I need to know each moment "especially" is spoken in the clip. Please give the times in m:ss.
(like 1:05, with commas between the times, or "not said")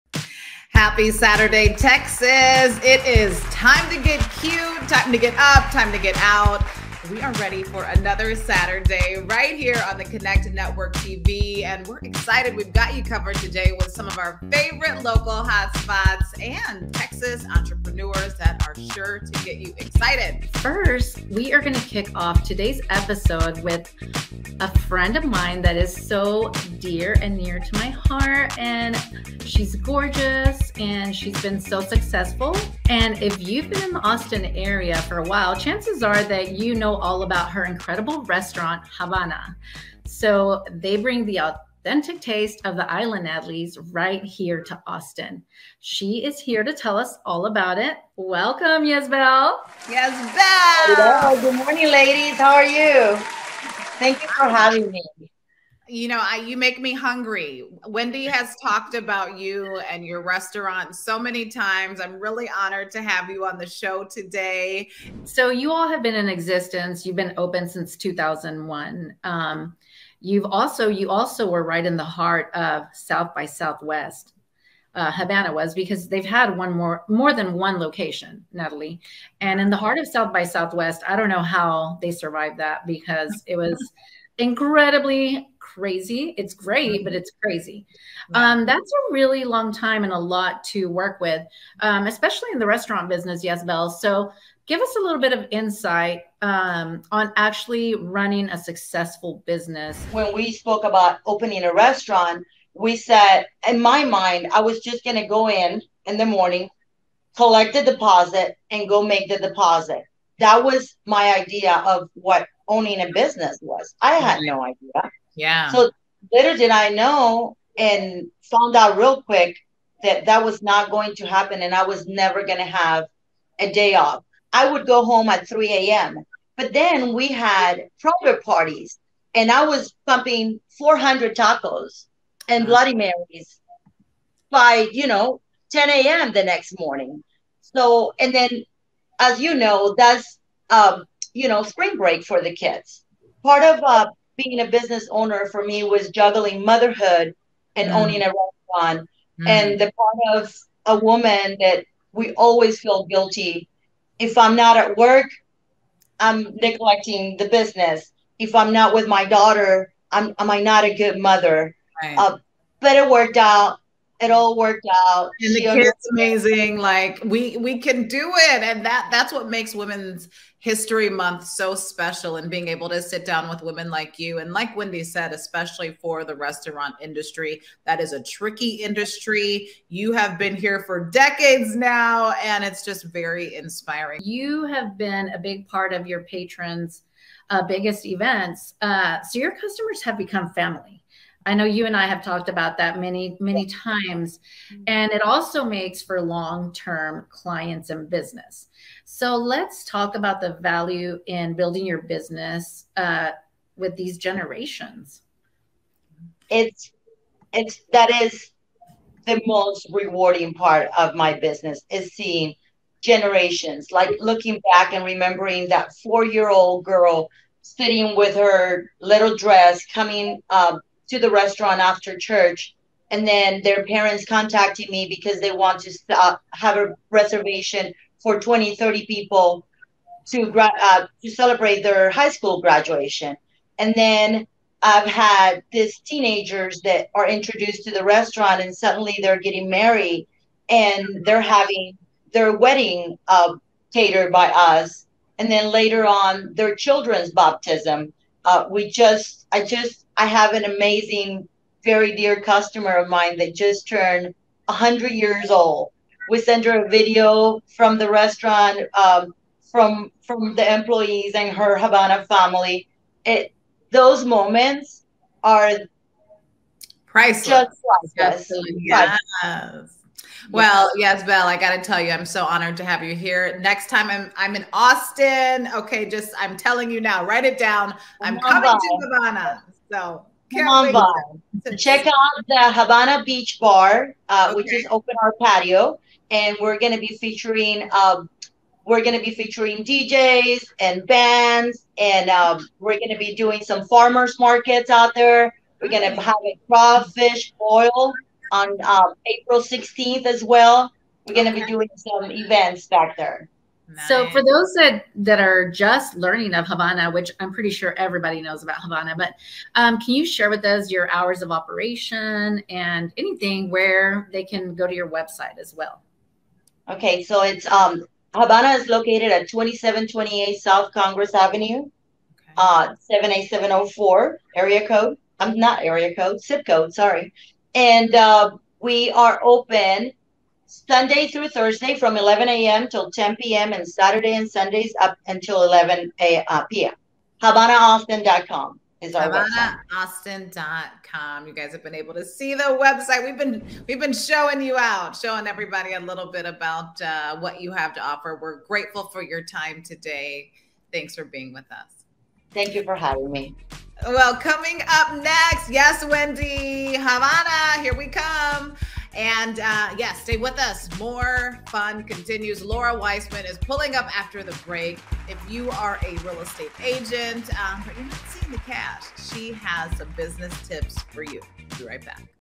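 1:32, 2:55.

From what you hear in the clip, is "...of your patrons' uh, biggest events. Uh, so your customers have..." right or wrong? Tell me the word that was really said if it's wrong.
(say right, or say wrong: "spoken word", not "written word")
right.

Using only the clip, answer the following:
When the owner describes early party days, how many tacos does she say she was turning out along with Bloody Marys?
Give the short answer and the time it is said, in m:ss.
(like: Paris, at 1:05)
400, at 2:10.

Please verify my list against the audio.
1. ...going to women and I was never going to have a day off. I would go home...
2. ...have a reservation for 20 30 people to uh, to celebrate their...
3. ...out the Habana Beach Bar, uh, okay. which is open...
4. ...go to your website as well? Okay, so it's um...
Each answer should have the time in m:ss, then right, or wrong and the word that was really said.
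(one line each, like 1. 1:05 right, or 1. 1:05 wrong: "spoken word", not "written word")
1. 2:00 wrong: "happen", not "women"
2. 3:46 right
3. 4:42 right
4. 5:14 right.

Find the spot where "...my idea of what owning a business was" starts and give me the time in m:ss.
1:51.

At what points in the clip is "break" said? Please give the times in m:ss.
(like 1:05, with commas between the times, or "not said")
2:21, 6:04.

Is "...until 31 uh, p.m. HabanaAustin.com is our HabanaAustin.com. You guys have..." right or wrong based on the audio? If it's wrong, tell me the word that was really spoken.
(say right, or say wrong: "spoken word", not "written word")
wrong: "11", not "31".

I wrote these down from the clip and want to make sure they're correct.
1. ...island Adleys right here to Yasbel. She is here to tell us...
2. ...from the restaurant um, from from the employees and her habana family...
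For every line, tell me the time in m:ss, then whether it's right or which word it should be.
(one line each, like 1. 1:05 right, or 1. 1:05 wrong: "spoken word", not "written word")
1. 0:42 wrong: "Austin", not "Yasbel"
2. 4:17 right.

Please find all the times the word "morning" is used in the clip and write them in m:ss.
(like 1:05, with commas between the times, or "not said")
0:51, 1:46, 2:16.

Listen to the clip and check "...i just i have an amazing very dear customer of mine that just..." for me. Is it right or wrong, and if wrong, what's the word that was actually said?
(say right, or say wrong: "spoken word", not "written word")
right.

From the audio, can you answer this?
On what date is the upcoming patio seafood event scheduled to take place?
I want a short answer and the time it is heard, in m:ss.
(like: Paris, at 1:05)
April 16, at 4:59.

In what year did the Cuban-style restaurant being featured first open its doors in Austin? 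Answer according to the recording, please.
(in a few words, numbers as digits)
2001.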